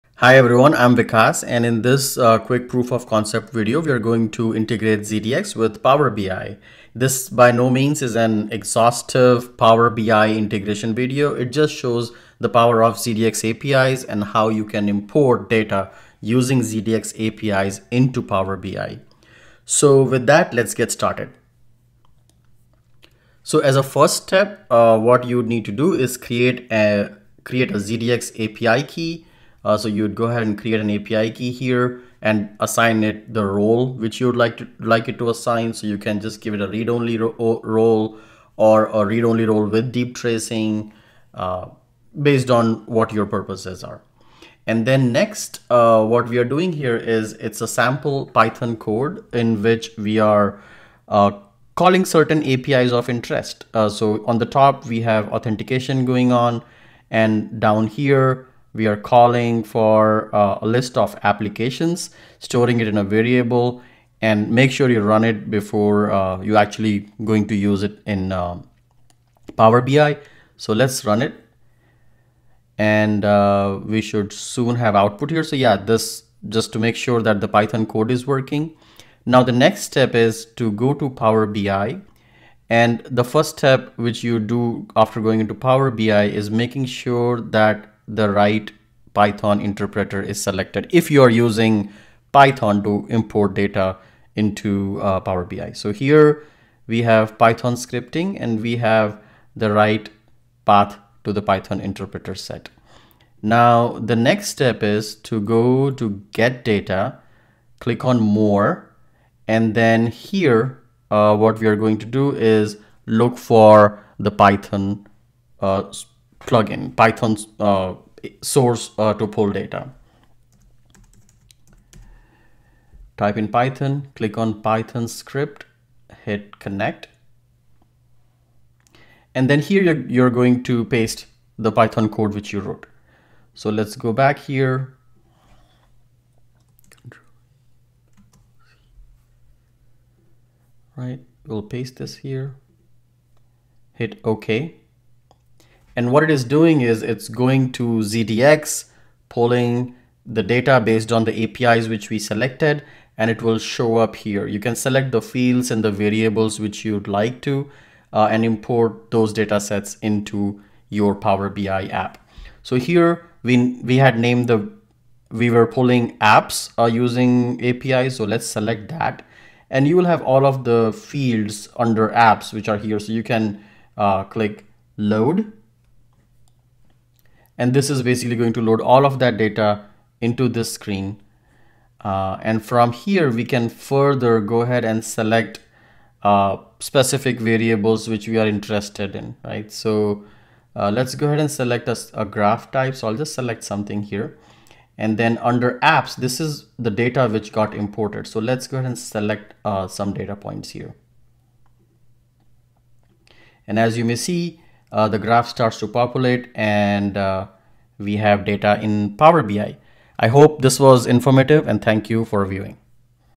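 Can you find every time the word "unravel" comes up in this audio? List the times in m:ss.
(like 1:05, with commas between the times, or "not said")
not said.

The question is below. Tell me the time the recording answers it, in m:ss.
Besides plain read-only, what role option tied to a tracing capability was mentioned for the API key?
0:39.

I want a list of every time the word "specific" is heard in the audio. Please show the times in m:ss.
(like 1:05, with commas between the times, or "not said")
3:06.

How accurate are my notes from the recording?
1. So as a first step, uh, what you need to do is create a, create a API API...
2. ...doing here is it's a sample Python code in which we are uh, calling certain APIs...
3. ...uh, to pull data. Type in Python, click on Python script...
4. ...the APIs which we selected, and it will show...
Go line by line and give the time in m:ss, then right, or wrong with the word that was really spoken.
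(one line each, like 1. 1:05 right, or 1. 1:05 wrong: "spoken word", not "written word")
1. 0:23 wrong: "ZDX", not "API"
2. 0:46 right
3. 1:58 right
4. 2:31 right.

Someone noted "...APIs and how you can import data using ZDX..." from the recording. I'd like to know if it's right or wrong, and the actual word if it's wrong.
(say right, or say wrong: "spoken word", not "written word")
right.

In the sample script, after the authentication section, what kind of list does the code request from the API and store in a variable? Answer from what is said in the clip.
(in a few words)
A list of applications.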